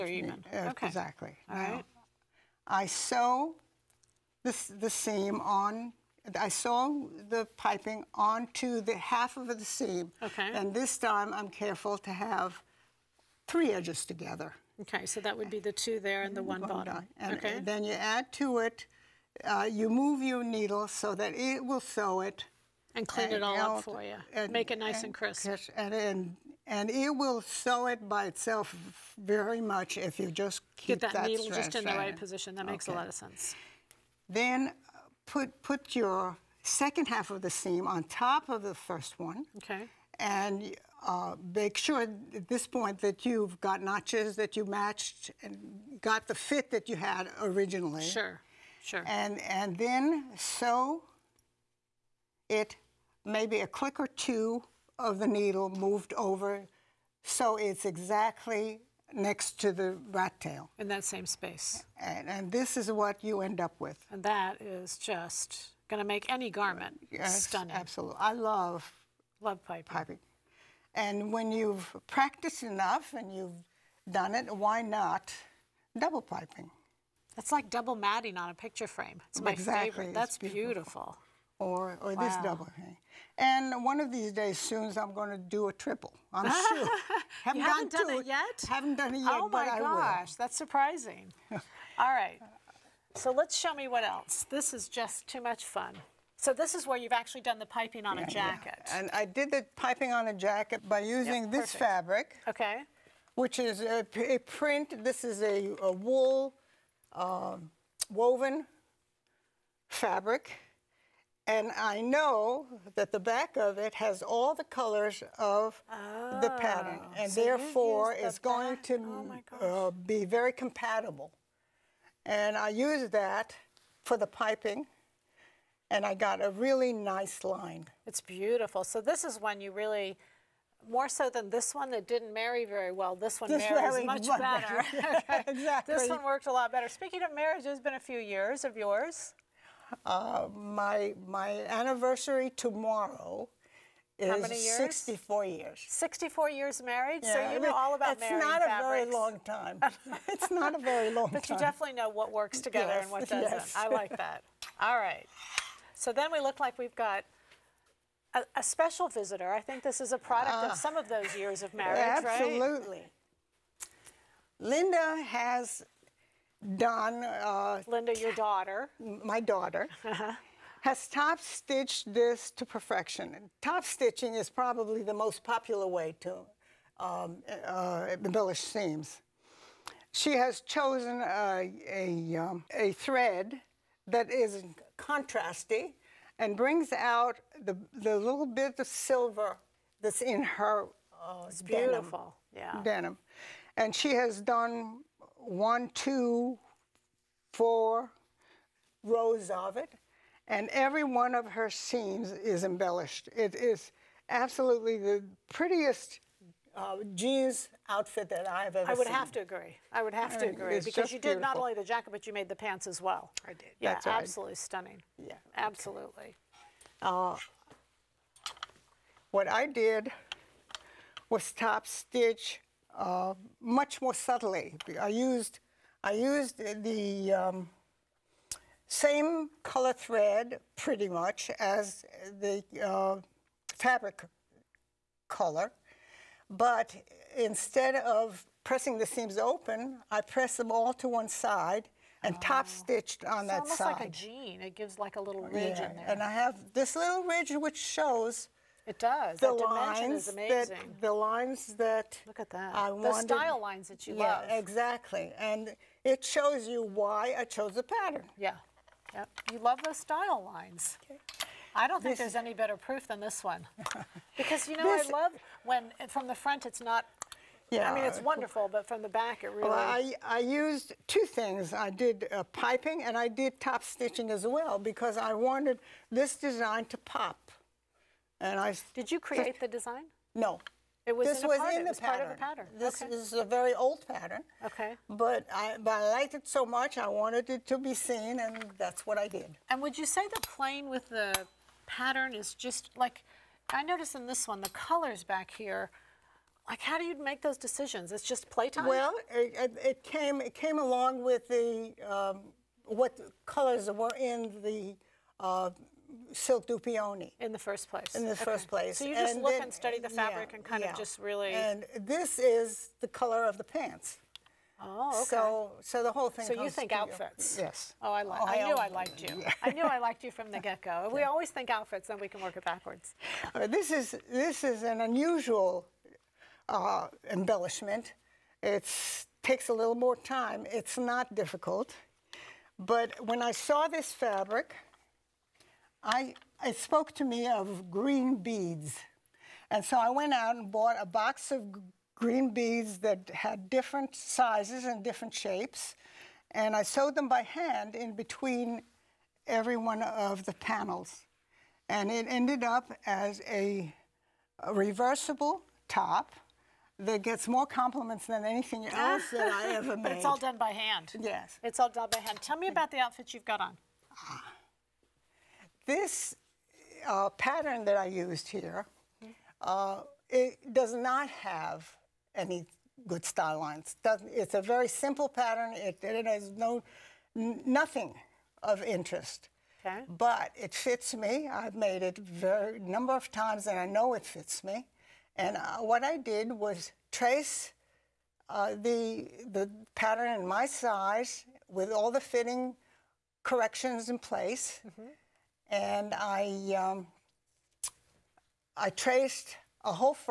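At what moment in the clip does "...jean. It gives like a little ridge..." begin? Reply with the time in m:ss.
4:04.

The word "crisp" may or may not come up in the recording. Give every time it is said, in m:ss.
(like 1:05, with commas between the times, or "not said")
0:25.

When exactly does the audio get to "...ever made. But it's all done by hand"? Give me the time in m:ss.
5:59.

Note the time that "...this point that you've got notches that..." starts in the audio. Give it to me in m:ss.
0:42.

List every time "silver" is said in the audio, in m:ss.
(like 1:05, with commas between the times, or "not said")
3:08.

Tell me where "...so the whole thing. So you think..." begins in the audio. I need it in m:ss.
5:15.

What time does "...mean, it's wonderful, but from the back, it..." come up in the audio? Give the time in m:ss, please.
4:27.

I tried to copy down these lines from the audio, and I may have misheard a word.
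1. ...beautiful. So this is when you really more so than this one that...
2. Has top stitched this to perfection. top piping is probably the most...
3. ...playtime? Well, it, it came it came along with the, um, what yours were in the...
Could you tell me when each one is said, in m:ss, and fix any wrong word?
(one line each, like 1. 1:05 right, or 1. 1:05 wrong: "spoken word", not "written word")
1. 2:08 right
2. 2:50 wrong: "stitching", not "piping"
3. 4:58 wrong: "colors", not "yours".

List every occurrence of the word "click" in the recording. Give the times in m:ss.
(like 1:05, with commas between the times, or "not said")
0:53.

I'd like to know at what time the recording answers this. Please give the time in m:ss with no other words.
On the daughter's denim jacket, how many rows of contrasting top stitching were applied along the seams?
3:17.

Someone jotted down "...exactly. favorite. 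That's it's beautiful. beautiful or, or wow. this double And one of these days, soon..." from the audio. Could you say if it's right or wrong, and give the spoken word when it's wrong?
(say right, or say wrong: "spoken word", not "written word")
right.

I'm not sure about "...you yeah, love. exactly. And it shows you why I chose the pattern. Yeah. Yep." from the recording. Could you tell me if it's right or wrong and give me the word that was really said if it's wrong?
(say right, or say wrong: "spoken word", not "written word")
right.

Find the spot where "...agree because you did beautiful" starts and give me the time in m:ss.
3:30.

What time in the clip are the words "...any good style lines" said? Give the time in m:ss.
6:12.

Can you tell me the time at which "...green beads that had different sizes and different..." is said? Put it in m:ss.
5:42.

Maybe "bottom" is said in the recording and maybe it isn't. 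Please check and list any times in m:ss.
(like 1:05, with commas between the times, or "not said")
0:16.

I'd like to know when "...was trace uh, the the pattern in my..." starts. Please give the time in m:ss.
6:26.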